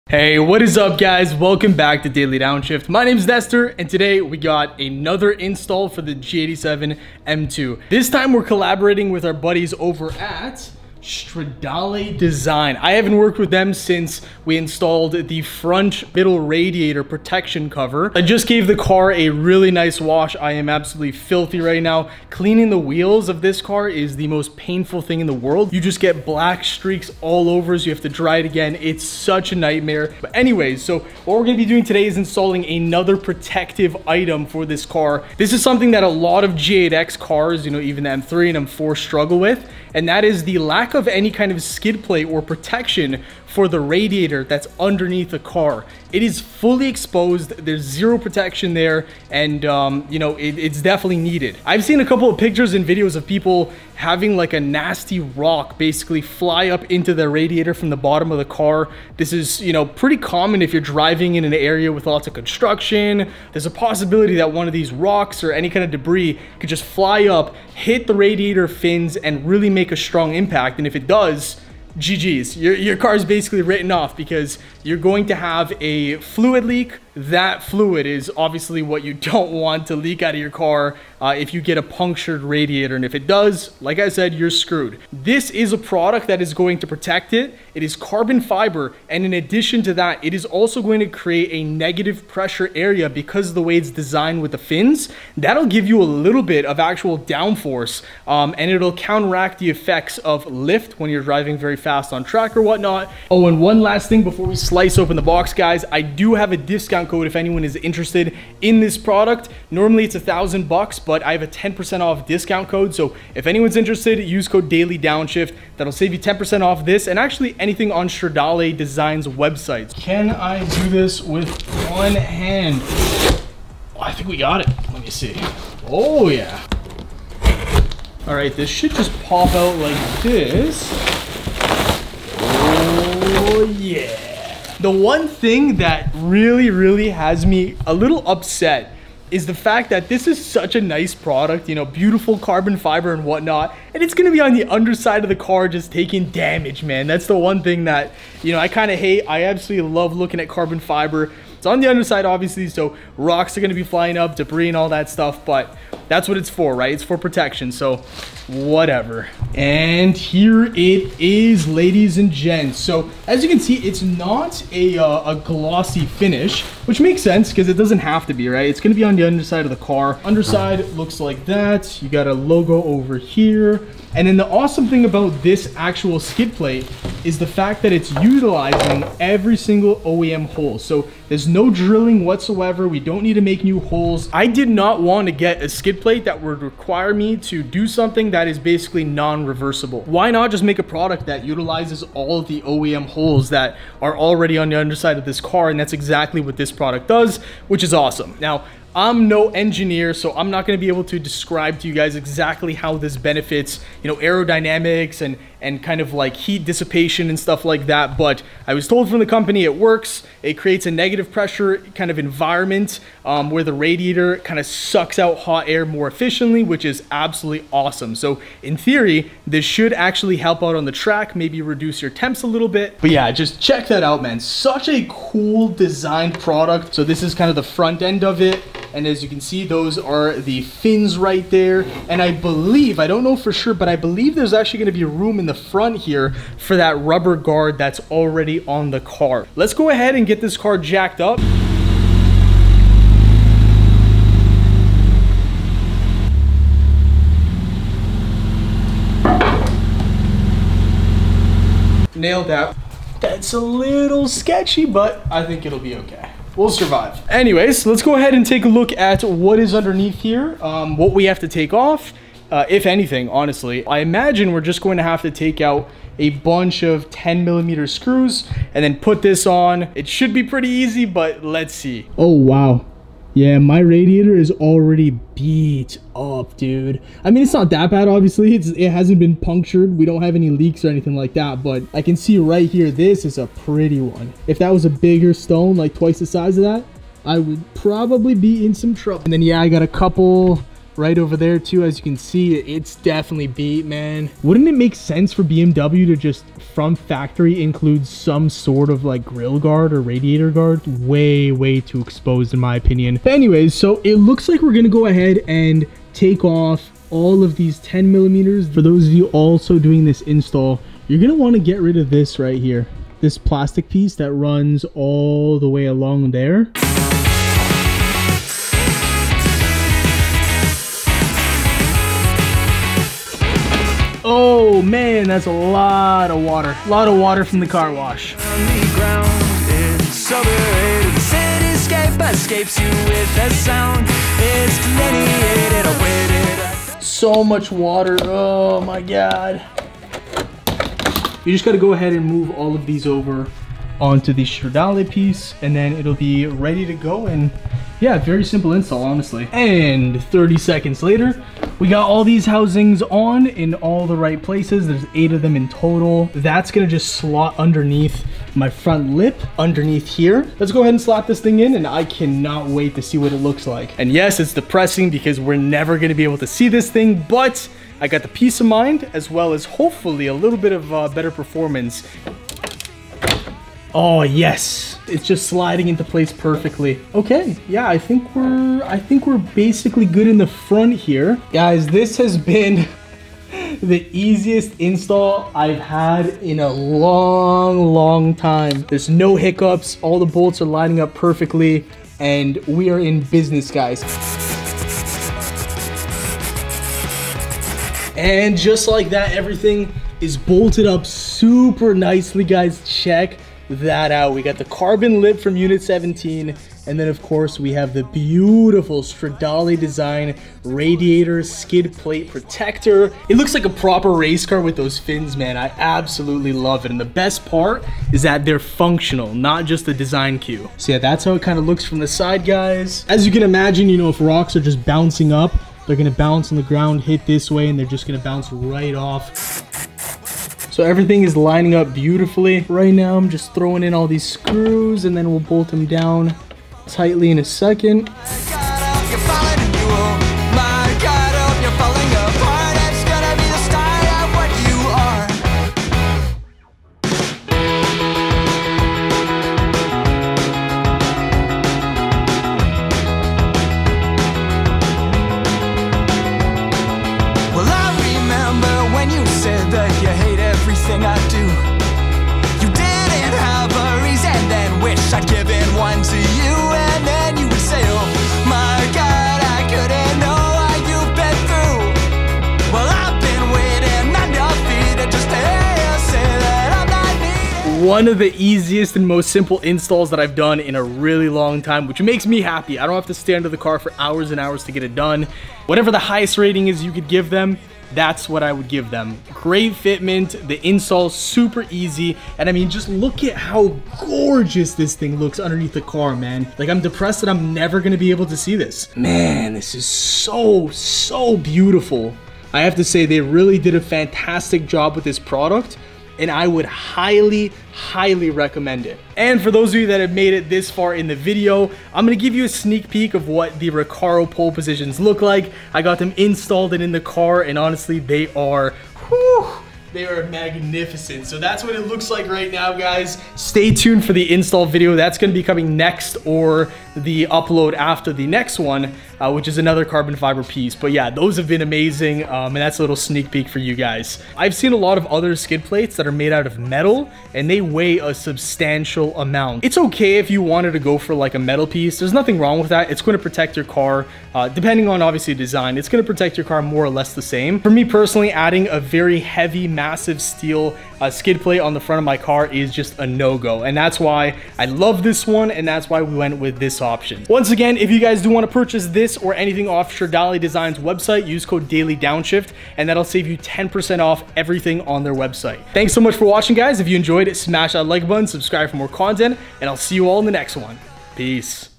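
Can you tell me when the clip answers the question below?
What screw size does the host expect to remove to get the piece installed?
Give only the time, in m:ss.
4:27.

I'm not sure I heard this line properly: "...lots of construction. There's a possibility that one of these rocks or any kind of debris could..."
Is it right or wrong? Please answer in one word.
right.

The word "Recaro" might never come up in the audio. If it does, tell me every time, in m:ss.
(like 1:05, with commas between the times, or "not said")
8:33.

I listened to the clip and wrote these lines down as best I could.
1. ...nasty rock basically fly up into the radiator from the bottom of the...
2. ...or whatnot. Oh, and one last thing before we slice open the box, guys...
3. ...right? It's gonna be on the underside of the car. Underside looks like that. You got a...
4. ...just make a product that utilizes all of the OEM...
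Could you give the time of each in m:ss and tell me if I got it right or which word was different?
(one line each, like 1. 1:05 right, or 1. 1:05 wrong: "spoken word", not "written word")
1. 0:54 right
2. 1:42 right
3. 2:48 right
4. 3:10 right.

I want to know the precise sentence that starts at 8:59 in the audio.
It's okay if you wanted to go for like a metal piece.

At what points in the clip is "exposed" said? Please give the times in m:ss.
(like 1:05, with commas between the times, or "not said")
0:46, 5:02.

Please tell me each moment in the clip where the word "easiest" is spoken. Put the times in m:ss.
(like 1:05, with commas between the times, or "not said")
6:24, 7:58.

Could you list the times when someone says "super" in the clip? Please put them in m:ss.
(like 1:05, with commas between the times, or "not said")
6:41, 8:11.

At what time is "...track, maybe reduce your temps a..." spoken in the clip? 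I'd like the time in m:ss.
3:40.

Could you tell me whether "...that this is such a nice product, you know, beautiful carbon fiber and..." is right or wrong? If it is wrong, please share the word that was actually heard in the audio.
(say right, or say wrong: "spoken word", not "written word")
right.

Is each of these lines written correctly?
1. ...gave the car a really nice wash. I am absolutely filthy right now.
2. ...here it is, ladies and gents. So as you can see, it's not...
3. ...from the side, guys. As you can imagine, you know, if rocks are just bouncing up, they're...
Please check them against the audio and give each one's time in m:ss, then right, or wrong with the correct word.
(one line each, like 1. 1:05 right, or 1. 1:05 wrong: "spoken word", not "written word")
1. 0:18 right
2. 2:40 right
3. 7:01 right.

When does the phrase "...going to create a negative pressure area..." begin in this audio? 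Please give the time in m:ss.
1:30.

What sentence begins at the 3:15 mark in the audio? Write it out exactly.
And that's exactly what this product does, which is awesome.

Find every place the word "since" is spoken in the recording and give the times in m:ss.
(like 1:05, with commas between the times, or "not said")
0:13.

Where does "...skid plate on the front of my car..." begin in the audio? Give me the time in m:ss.
9:11.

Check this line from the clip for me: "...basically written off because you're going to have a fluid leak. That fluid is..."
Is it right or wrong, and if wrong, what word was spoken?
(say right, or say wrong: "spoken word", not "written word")
right.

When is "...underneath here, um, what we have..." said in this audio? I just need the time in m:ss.
4:19.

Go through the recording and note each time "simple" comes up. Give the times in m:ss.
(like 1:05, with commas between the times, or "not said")
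5:48, 7:59.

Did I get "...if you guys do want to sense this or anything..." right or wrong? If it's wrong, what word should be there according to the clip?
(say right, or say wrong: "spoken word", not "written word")
wrong: "purchase", not "sense".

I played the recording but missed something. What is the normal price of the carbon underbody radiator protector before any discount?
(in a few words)
1000 dollars.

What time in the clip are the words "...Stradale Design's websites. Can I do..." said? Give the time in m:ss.
1:58.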